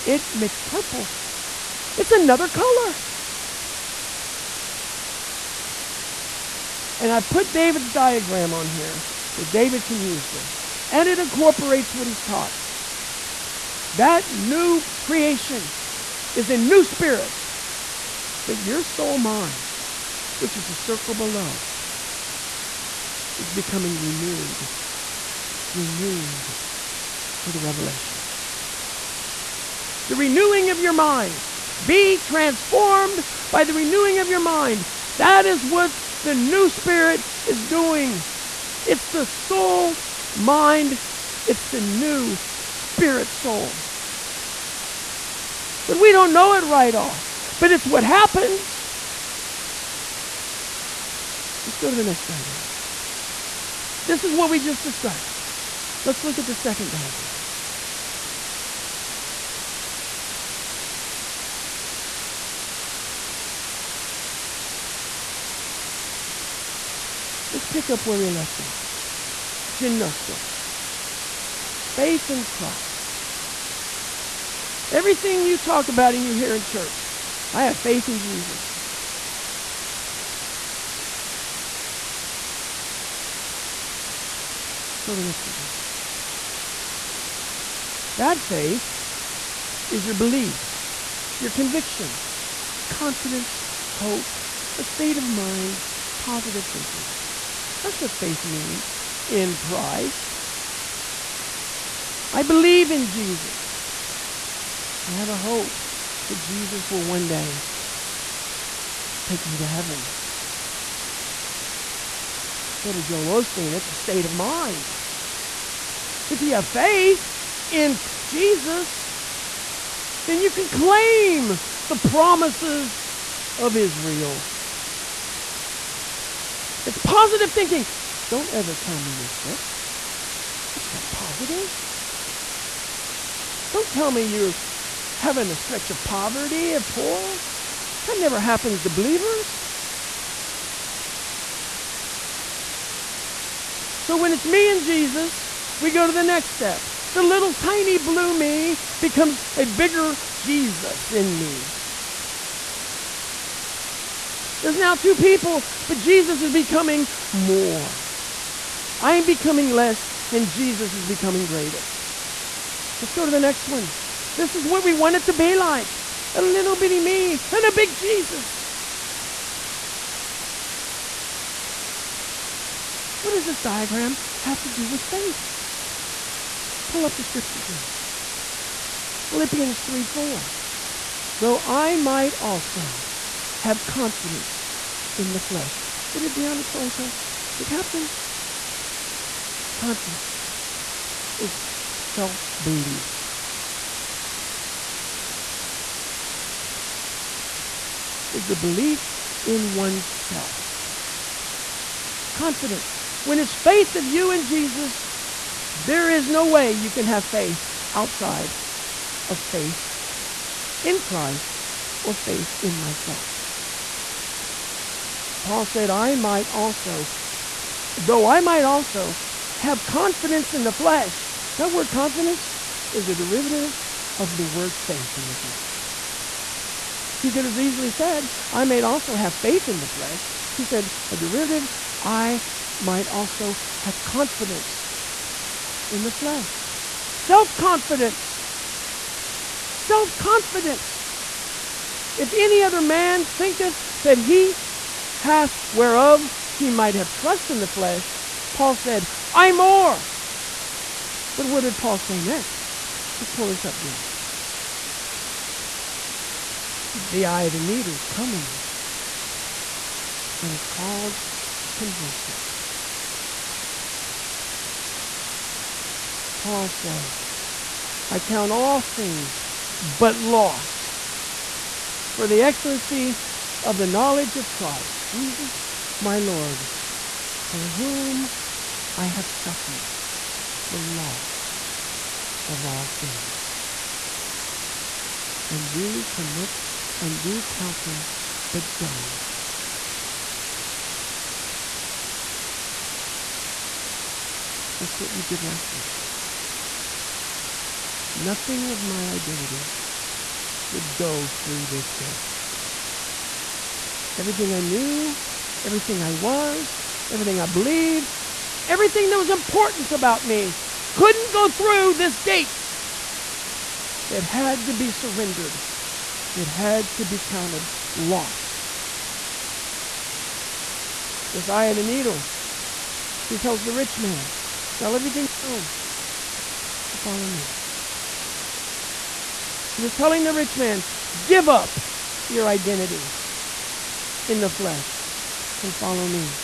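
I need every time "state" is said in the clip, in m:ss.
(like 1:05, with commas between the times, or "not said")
1:34, 1:53.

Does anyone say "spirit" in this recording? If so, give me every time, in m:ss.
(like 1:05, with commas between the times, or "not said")
0:16, 0:36, 0:42.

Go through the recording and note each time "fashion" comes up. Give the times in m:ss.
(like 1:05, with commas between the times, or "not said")
not said.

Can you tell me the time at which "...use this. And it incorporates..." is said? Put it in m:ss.
0:10.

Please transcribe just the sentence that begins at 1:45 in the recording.
I have a hope that Jesus will one day take me to heaven go to Joel Osteen.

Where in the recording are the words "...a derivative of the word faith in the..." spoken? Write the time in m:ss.
3:43.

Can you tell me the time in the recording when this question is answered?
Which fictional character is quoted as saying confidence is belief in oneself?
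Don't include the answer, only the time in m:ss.
3:06.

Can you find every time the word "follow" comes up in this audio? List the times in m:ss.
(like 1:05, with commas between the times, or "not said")
5:26, 5:35.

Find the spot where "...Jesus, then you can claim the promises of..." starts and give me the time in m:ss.
1:58.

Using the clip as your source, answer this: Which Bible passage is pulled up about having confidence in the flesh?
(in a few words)
Philippians 3:4.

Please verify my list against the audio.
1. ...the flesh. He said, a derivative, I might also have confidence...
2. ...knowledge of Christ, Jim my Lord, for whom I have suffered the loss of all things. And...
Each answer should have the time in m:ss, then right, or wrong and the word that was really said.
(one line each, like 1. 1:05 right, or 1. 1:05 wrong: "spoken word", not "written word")
1. 3:49 right
2. 4:33 wrong: "Jesus", not "Jim".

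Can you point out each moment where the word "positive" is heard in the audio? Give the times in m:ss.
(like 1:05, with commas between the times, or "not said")
1:36, 2:06, 2:11.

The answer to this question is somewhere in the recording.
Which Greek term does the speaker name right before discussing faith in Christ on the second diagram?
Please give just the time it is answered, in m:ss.
1:09.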